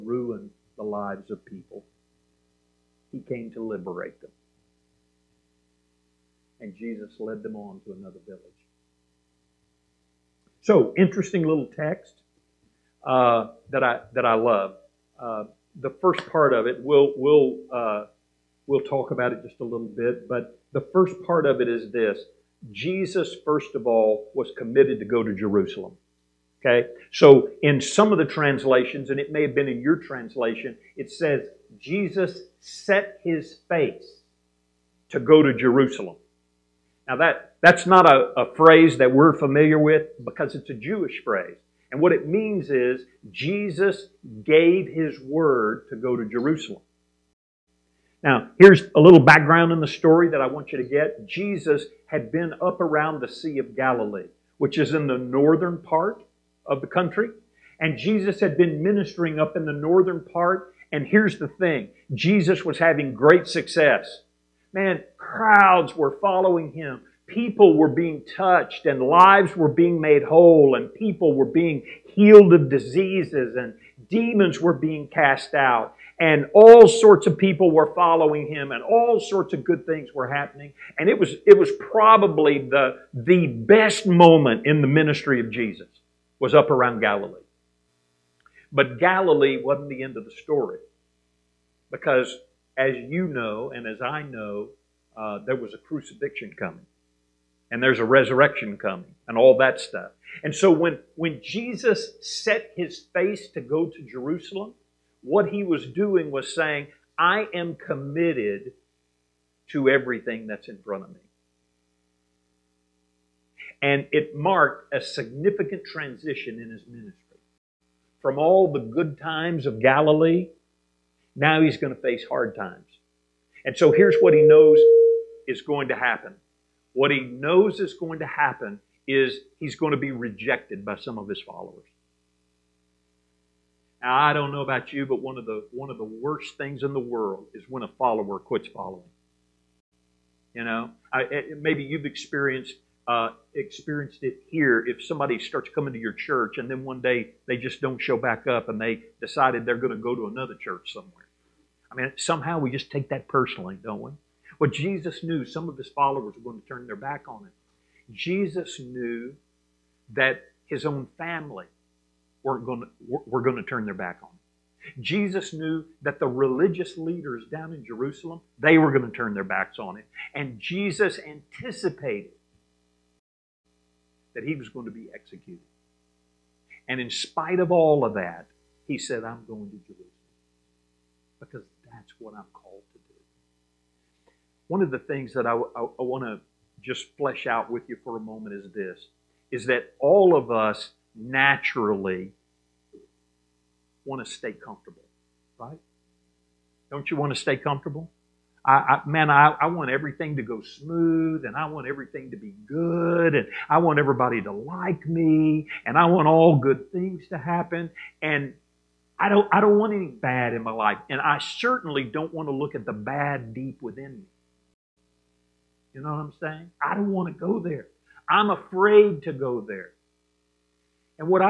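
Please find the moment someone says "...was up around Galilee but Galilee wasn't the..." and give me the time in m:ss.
1:26.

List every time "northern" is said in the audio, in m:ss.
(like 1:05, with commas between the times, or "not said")
0:55, 0:59.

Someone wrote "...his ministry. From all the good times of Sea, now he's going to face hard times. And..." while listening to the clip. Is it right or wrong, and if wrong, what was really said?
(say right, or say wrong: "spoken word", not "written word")
wrong: "Galilee", not "Sea".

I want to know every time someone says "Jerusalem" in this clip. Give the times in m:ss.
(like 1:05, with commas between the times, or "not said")
0:25, 0:35, 0:46, 1:44, 2:47, 2:59.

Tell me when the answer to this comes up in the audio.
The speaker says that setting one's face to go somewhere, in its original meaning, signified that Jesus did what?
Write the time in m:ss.
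0:44.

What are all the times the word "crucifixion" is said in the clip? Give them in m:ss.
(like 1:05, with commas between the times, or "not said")
1:35.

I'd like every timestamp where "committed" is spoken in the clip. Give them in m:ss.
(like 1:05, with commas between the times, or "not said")
0:24, 1:47.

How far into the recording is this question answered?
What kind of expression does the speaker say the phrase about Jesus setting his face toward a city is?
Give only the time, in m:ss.
0:40.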